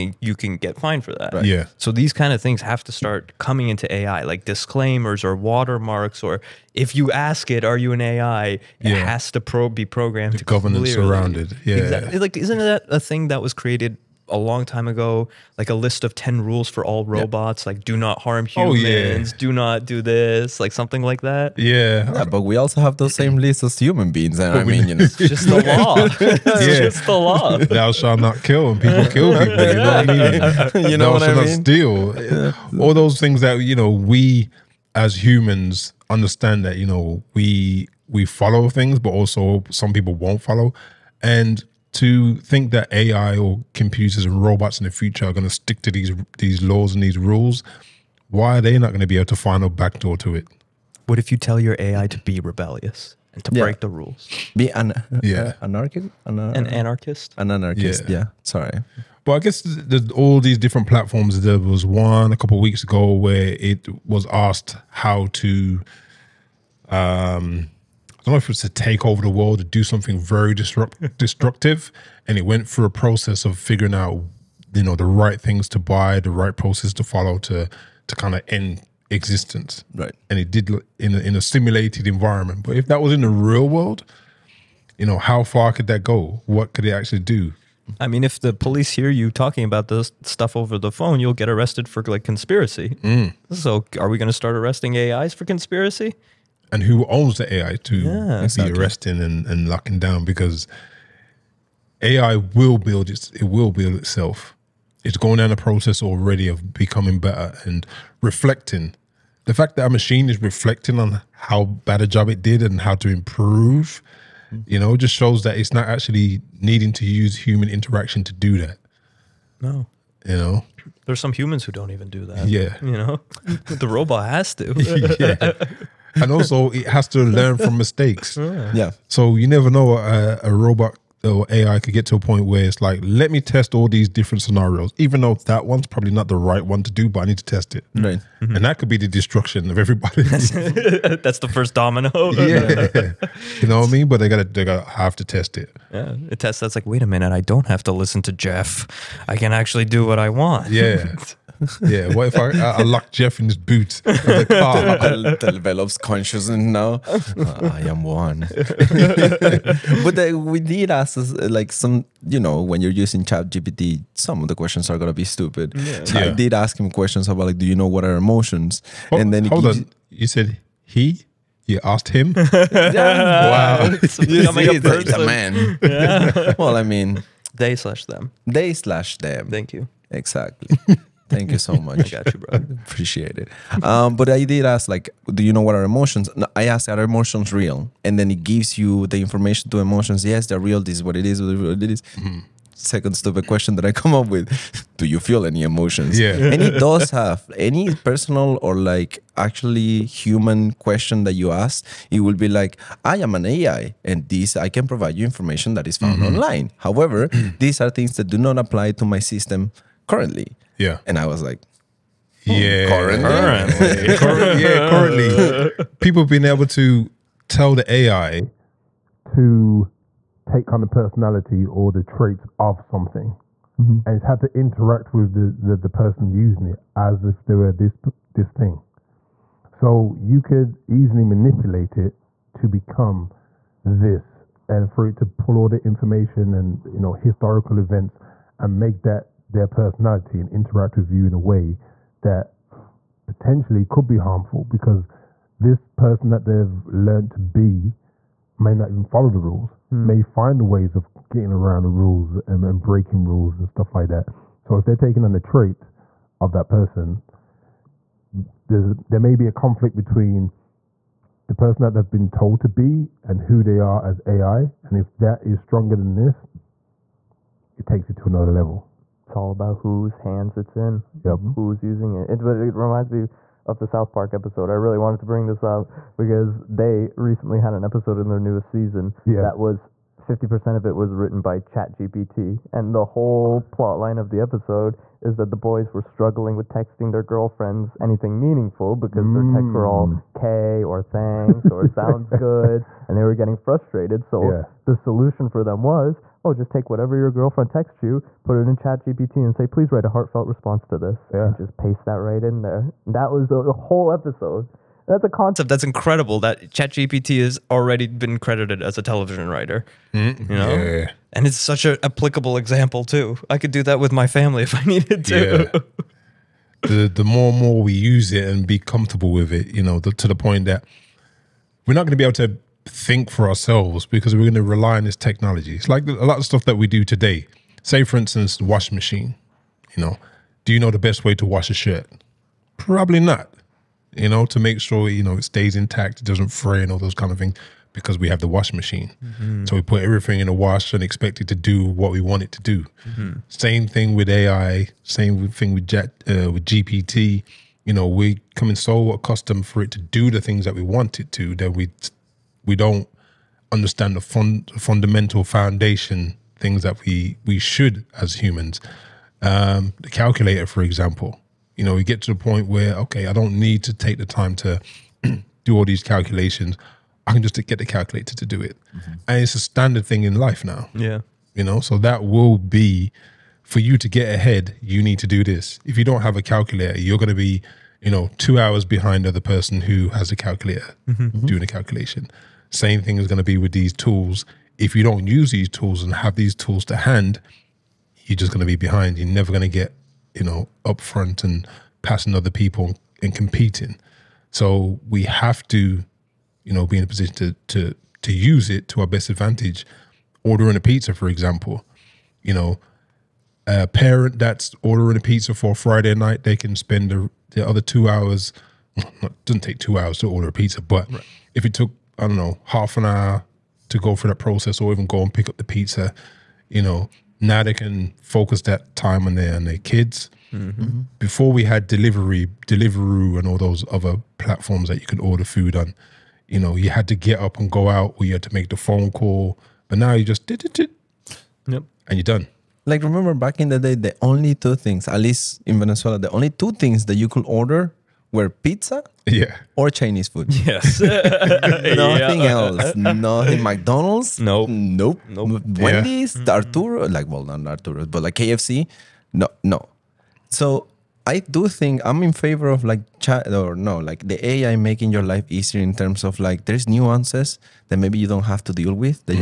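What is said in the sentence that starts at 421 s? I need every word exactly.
Before we had delivery, Deliveroo, and all those other platforms that you could order food on.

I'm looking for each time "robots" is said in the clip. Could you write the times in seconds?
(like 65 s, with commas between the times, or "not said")
17 s, 44 s, 123 s, 130 s.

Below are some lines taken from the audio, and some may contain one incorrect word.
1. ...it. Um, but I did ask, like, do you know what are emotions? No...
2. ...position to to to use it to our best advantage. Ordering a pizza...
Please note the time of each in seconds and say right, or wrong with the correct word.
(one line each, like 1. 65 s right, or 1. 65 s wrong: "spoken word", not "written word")
1. 183 s right
2. 397 s right.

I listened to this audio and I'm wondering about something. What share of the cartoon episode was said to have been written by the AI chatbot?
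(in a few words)
50%.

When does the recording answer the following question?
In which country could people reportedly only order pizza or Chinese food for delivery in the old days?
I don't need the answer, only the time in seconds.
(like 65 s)
435 s.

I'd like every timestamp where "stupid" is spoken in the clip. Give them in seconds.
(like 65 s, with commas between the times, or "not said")
165 s, 193 s.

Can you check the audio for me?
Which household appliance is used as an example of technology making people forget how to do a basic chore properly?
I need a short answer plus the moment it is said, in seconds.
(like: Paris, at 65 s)
Washing machine, at 328 s.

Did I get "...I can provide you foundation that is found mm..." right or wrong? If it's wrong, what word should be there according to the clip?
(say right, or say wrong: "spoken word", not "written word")
wrong: "information", not "foundation".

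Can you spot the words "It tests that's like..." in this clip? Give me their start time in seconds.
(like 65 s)
146 s.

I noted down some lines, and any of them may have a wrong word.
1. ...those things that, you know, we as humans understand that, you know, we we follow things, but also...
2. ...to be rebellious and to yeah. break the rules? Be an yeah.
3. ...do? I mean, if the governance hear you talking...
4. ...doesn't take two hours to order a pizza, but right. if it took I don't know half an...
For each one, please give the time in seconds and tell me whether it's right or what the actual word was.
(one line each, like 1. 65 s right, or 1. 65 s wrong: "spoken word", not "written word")
1. 32 s right
2. 52 s right
3. 87 s wrong: "police", not "governance"
4. 409 s right.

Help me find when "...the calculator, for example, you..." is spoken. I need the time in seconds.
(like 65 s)
359 s.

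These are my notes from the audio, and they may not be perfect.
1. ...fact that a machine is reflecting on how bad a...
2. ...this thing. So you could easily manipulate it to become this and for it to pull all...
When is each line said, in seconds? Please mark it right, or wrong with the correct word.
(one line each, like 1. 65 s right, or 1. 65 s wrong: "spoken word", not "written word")
1. 109 s right
2. 228 s right.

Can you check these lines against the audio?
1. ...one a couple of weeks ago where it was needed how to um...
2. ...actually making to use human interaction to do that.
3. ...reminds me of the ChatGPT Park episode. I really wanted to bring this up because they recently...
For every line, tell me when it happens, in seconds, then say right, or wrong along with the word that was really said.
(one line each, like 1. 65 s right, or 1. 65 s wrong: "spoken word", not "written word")
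1. 61 s wrong: "asked", not "needed"
2. 115 s wrong: "needing", not "making"
3. 272 s wrong: "South", not "ChatGPT".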